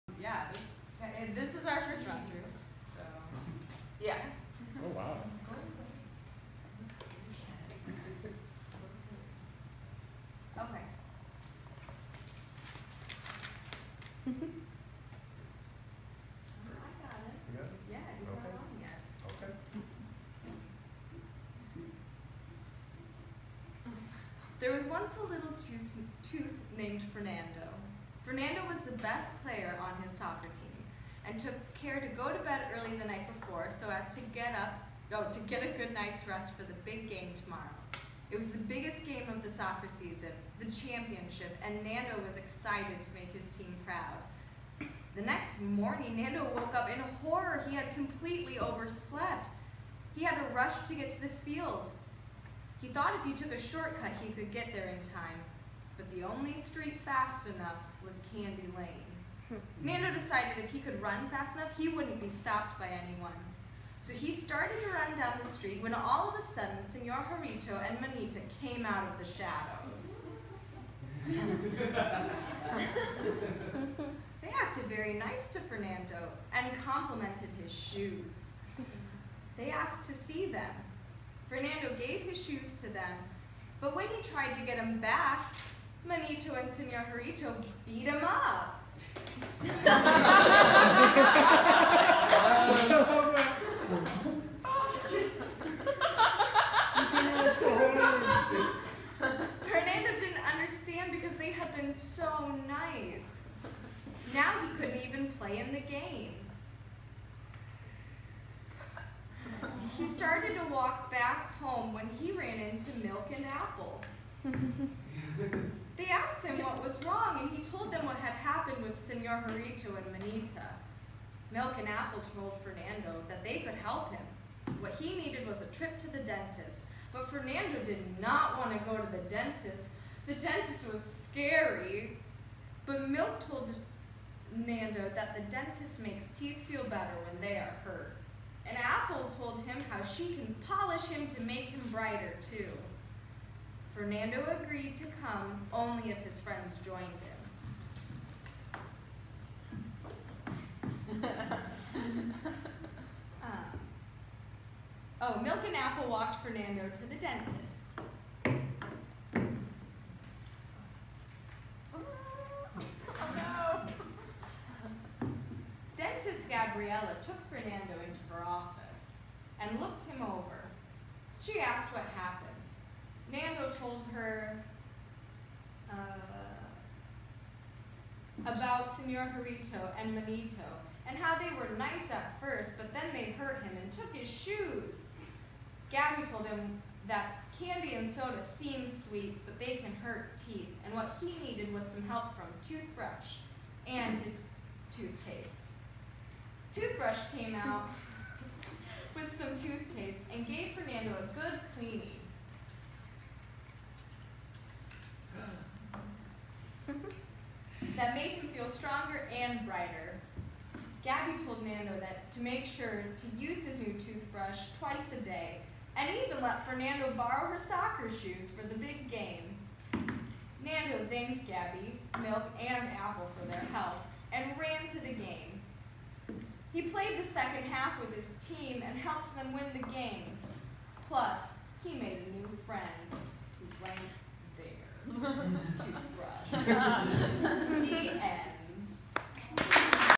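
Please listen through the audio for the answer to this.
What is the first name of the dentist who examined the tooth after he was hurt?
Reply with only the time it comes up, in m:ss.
2:46.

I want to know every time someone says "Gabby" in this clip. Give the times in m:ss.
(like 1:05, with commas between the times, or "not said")
3:05, 3:31, 3:41.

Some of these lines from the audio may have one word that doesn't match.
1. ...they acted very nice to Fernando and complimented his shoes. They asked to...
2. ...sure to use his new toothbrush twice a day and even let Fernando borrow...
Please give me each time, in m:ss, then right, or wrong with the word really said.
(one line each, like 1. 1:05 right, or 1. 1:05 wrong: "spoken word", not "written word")
1. 1:14 right
2. 3:32 right.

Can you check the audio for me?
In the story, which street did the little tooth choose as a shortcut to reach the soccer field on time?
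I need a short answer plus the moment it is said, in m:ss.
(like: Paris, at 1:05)
Candy Lane, at 0:58.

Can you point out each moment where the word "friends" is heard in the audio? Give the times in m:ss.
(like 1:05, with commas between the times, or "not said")
2:26, 3:52.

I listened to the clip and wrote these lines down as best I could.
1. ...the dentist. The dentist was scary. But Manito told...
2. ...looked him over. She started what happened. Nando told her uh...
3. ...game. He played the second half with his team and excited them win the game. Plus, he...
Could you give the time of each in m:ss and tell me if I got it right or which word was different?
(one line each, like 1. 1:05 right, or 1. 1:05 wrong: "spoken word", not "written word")
1. 2:09 wrong: "Milk", not "Manito"
2. 2:49 wrong: "asked", not "started"
3. 3:45 wrong: "helped", not "excited".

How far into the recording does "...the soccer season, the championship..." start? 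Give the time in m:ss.
0:39.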